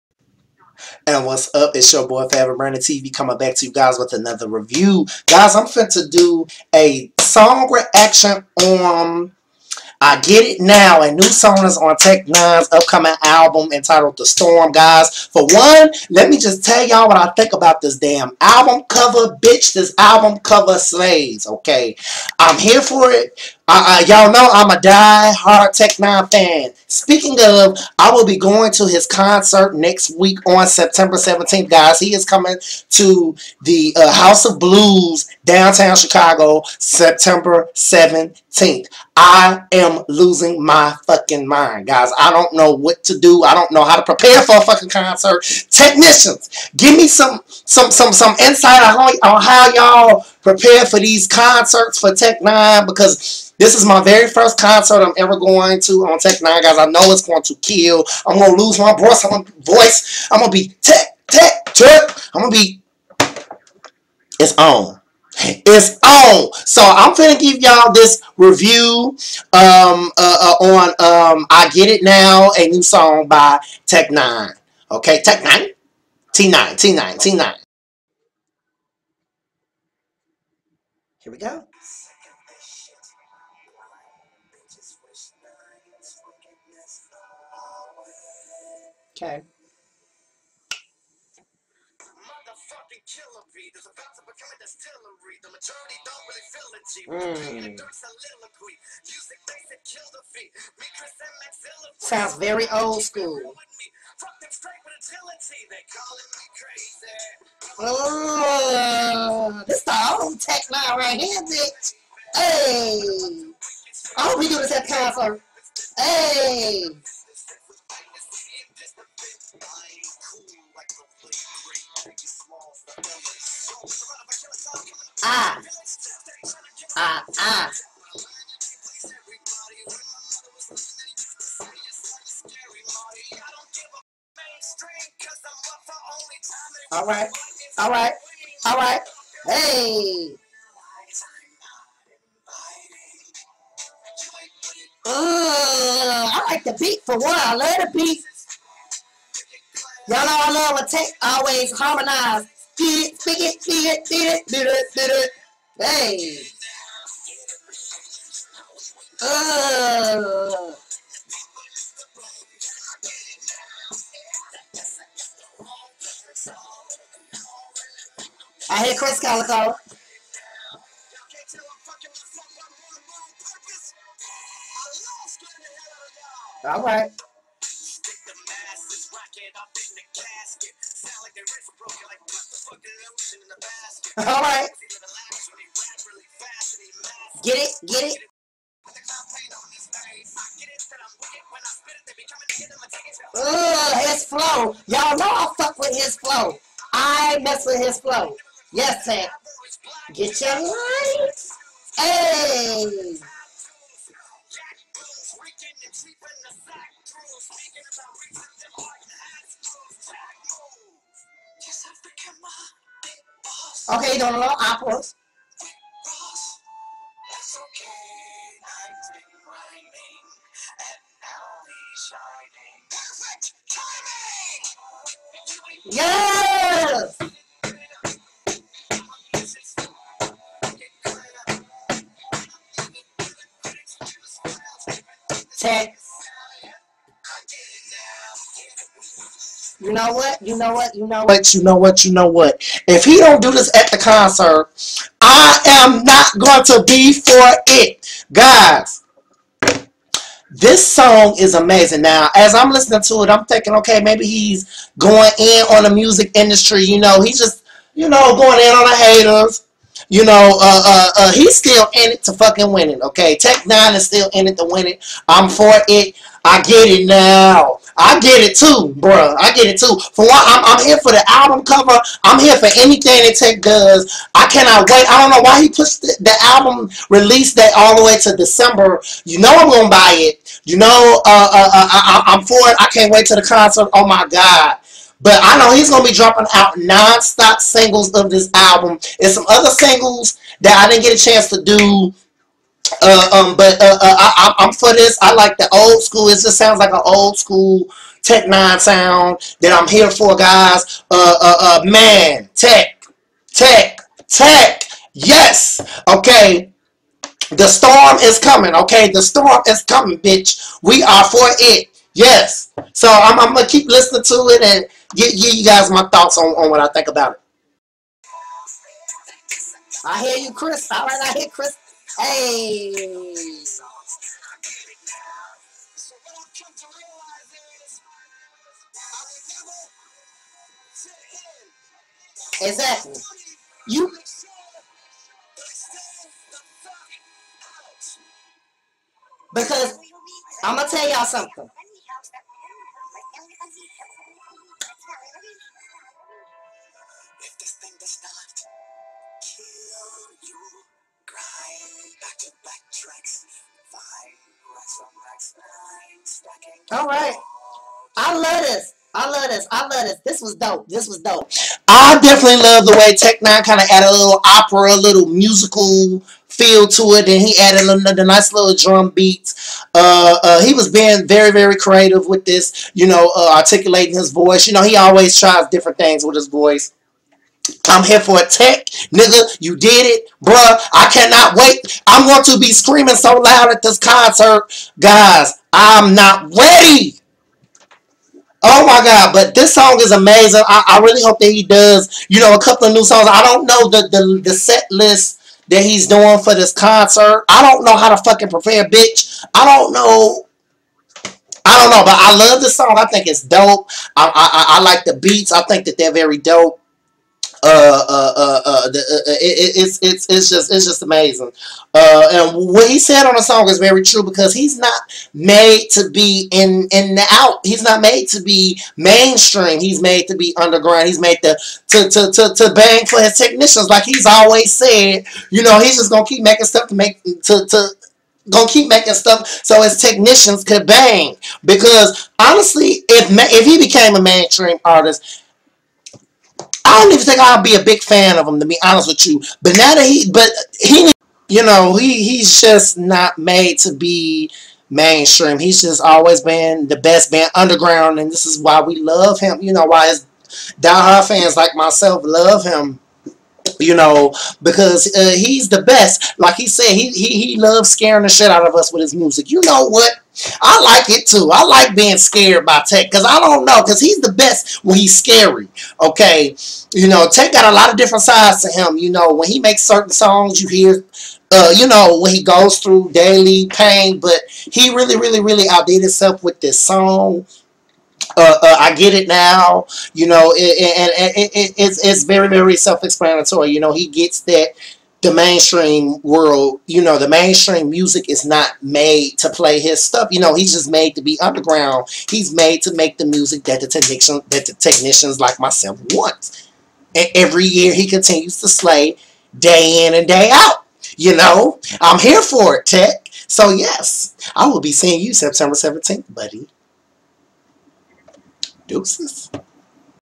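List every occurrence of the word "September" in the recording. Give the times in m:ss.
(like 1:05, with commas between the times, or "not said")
0:30, 0:36, 8:25.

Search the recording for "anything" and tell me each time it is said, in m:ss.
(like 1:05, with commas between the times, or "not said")
4:32.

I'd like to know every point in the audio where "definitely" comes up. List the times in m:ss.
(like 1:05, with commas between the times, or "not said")
6:02.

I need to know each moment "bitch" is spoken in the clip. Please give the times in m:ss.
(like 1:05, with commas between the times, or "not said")
0:19, 5:10, 6:38.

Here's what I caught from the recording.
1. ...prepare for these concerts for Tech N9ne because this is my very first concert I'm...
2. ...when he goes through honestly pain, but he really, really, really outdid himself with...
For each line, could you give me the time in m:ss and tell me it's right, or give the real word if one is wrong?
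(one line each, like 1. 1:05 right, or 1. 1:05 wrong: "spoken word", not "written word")
1. 0:50 right
2. 7:52 wrong: "daily", not "honestly".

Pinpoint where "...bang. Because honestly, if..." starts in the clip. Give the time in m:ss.
7:10.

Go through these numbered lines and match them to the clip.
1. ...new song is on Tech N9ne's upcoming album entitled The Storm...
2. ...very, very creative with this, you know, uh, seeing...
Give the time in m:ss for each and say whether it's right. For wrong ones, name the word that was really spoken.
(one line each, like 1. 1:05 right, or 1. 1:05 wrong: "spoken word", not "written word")
1. 0:11 right
2. 6:11 wrong: "articulating", not "seeing".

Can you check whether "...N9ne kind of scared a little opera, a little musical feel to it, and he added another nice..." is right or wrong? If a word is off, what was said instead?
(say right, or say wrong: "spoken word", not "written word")
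wrong: "added", not "scared".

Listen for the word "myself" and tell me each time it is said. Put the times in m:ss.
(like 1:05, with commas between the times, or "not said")
7:31, 8:15.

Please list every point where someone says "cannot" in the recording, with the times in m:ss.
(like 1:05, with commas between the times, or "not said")
4:34, 6:21.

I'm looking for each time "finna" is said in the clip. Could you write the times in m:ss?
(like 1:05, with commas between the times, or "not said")
1:07.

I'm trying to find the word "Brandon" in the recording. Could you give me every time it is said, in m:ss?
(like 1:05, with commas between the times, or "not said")
0:02.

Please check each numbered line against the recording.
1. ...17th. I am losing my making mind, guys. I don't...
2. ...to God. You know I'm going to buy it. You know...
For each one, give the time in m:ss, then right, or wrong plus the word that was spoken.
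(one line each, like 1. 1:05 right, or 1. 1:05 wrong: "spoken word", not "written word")
1. 0:37 wrong: "fucking", not "making"
2. 4:38 wrong: "December", not "God".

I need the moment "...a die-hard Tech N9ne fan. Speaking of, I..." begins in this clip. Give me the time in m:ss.
0:24.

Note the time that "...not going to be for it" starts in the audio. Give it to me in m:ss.
4:06.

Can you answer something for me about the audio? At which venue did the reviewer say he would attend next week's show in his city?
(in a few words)
House of Blues.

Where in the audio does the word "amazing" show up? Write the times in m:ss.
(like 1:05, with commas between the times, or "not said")
4:11, 6:30, 6:51.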